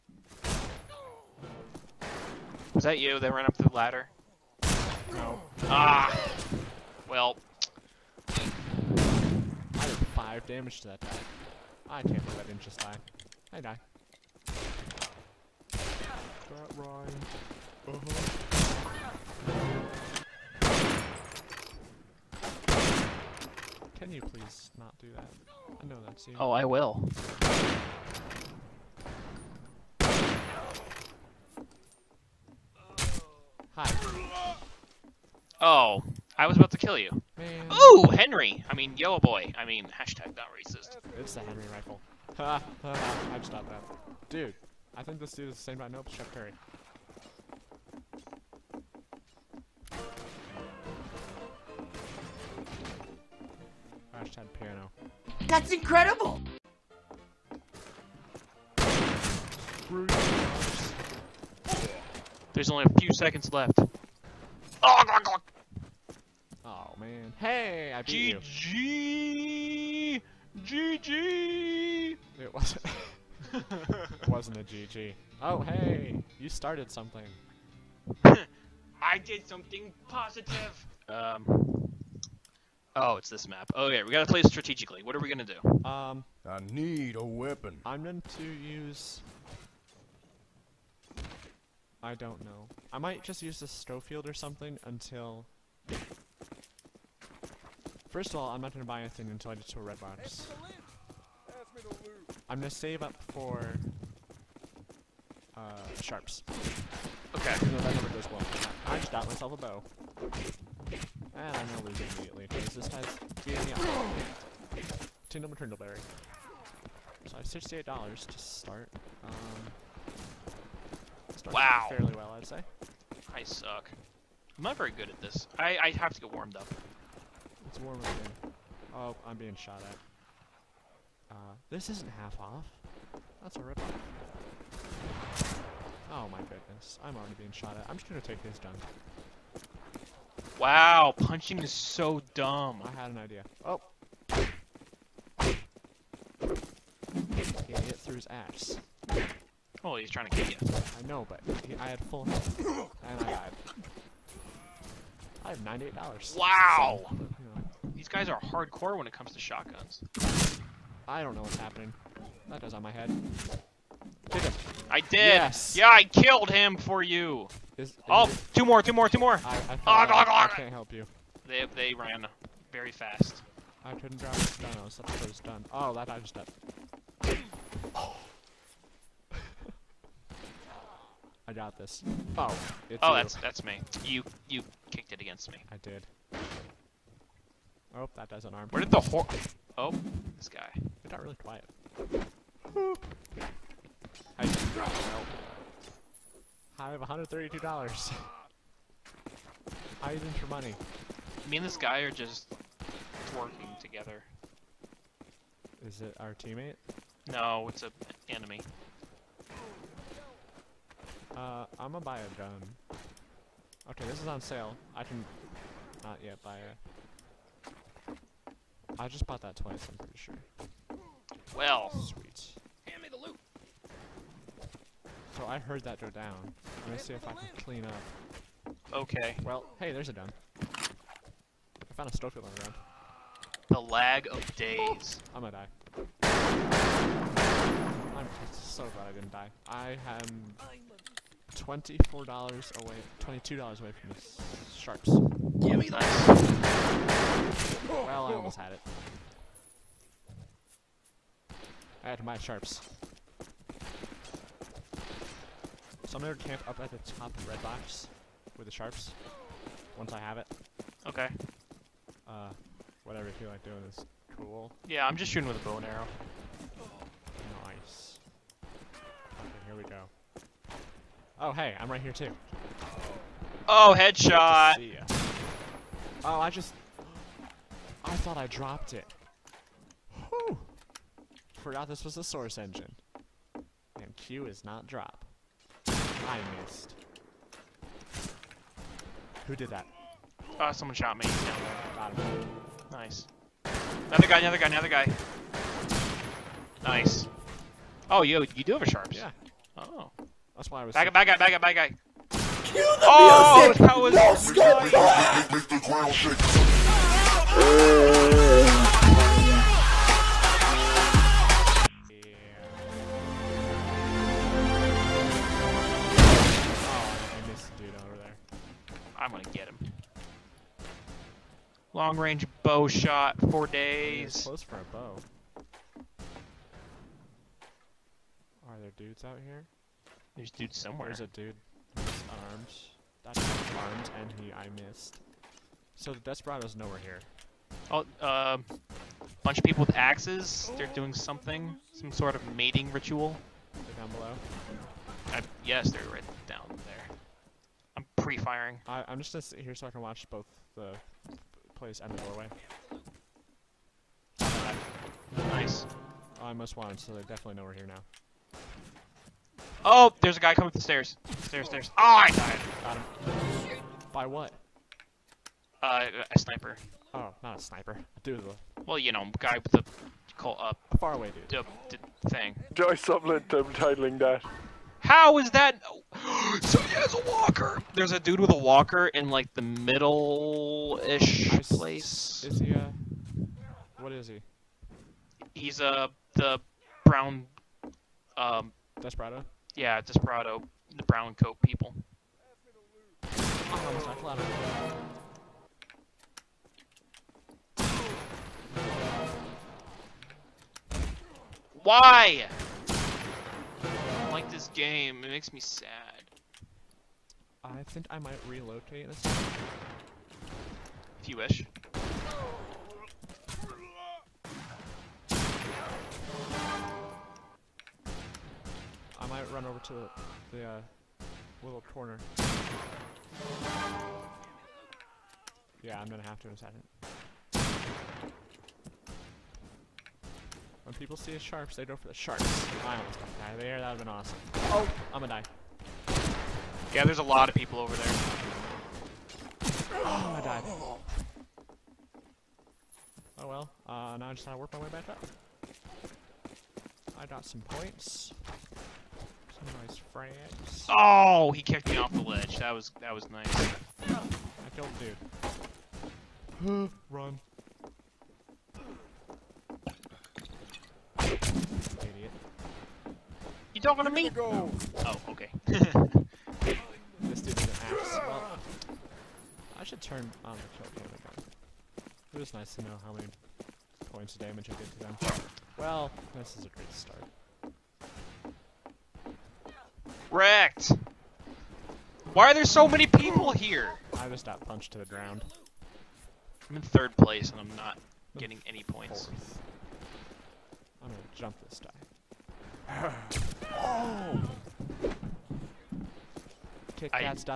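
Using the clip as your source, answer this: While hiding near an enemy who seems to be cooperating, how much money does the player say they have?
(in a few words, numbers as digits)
$132.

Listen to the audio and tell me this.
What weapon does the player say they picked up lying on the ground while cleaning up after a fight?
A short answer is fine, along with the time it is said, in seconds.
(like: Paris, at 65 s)
Stoker, at 232 s.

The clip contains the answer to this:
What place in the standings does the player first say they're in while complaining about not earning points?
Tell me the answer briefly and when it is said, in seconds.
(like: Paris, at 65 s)
Third, at 486 s.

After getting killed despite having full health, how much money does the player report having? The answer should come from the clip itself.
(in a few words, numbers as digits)
$98.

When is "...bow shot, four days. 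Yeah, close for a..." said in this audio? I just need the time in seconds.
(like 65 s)
322 s.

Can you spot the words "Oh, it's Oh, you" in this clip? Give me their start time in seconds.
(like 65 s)
182 s.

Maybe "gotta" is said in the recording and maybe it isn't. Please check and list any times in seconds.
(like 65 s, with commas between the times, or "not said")
84 s, 444 s.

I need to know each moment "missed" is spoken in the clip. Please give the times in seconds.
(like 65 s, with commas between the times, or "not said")
286 s, 334 s.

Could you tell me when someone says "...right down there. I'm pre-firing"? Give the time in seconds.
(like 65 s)
346 s.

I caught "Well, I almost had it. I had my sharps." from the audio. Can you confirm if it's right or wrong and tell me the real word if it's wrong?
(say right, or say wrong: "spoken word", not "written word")
right.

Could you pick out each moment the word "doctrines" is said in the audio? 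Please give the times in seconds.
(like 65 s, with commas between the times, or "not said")
not said.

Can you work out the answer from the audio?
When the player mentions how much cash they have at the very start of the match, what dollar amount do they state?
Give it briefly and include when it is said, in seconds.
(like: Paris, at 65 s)
$68, at 117 s.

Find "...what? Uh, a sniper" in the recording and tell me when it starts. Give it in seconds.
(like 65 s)
364 s.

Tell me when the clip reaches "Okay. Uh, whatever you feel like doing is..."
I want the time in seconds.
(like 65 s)
261 s.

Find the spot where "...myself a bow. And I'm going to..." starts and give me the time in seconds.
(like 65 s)
109 s.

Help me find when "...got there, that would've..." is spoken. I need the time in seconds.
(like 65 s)
433 s.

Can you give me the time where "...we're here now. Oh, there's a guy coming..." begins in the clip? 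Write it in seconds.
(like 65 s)
357 s.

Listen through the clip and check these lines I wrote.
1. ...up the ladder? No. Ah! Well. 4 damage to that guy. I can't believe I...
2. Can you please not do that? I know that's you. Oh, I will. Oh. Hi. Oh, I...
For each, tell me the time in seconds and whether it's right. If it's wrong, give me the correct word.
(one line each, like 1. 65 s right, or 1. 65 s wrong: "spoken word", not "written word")
1. 3 s wrong: "5", not "4"
2. 23 s right.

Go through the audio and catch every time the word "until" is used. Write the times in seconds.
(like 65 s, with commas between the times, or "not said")
94 s, 99 s.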